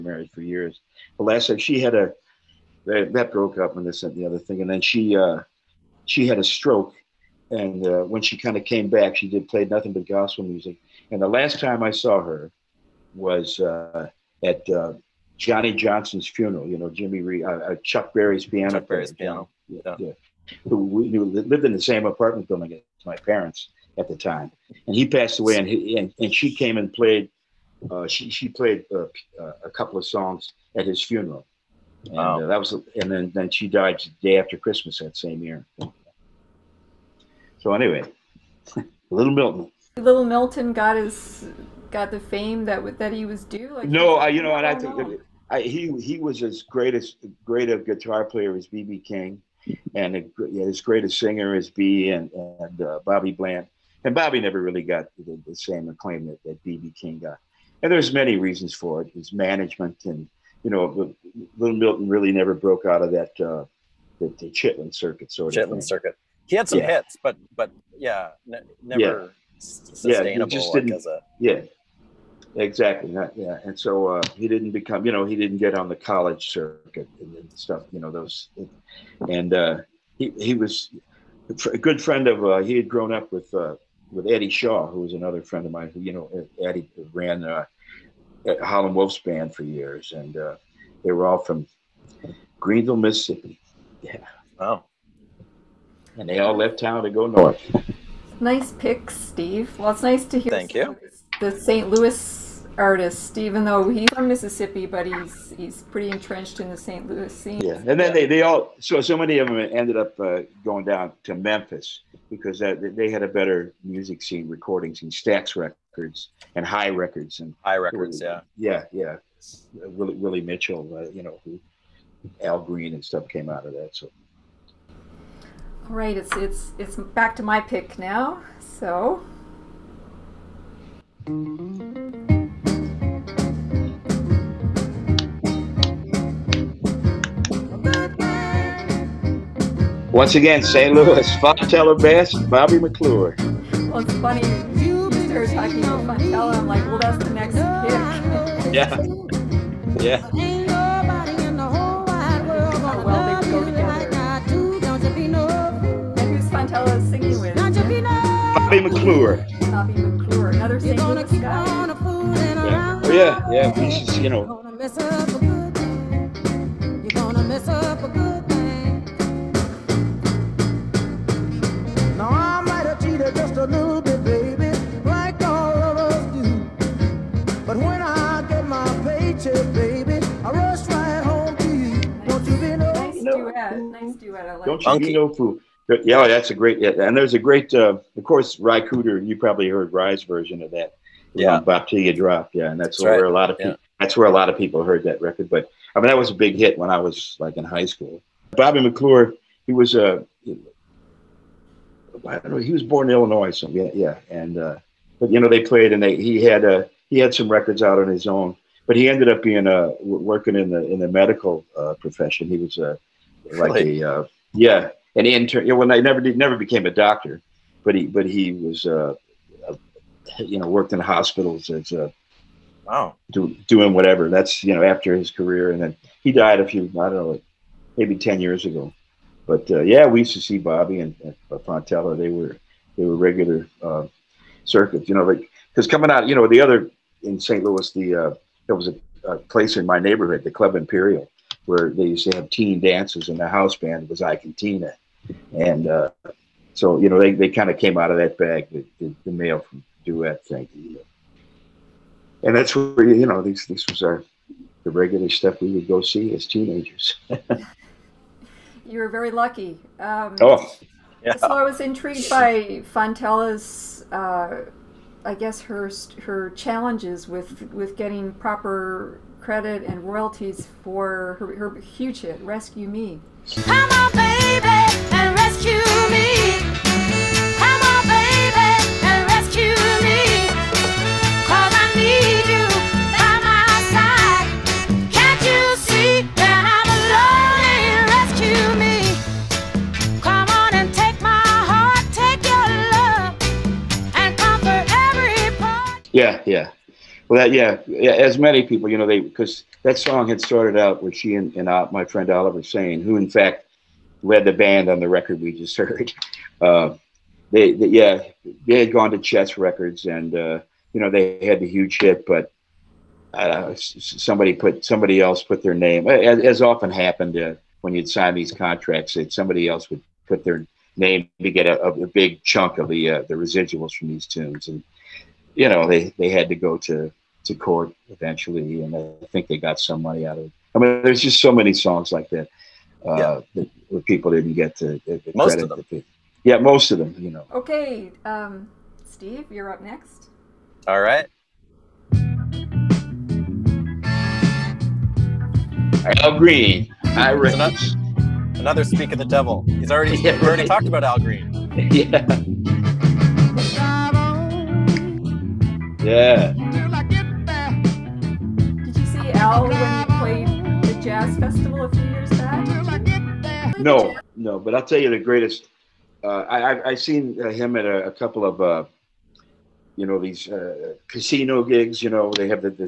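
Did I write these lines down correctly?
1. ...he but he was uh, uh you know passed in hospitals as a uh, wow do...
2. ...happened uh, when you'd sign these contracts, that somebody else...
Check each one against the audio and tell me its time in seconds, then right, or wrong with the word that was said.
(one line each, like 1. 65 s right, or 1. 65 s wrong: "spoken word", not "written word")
1. 217 s wrong: "worked", not "passed"
2. 316 s right.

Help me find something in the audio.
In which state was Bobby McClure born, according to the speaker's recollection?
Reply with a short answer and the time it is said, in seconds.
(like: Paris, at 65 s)
Illinois, at 203 s.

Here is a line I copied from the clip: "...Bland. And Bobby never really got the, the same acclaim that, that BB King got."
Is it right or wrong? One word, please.
right.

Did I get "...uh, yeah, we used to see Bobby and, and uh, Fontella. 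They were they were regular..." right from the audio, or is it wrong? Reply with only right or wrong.
right.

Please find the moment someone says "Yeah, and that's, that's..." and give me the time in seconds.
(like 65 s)
192 s.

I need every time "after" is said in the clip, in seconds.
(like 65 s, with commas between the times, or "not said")
34 s, 224 s.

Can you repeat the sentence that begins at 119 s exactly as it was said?
Willie, Willie Mitchell, uh, you know, who, Al Green and stuff came out of that.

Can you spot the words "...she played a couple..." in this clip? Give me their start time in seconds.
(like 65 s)
28 s.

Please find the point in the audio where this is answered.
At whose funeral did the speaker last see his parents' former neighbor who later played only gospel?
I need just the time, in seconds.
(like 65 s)
15 s.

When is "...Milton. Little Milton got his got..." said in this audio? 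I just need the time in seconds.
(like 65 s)
39 s.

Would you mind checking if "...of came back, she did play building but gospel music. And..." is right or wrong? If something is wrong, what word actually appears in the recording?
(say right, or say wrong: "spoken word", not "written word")
wrong: "nothing", not "building".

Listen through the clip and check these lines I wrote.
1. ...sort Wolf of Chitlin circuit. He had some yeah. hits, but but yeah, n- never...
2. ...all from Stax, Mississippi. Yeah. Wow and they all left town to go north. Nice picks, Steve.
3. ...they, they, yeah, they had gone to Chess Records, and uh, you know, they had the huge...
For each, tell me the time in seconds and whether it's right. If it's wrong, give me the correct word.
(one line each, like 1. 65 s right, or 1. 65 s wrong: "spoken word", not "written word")
1. 65 s wrong: "Chitlin", not "Wolf"
2. 91 s wrong: "Greenville", not "Stax"
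3. 307 s right.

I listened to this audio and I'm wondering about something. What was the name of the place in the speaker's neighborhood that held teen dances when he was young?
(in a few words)
Club Imperial.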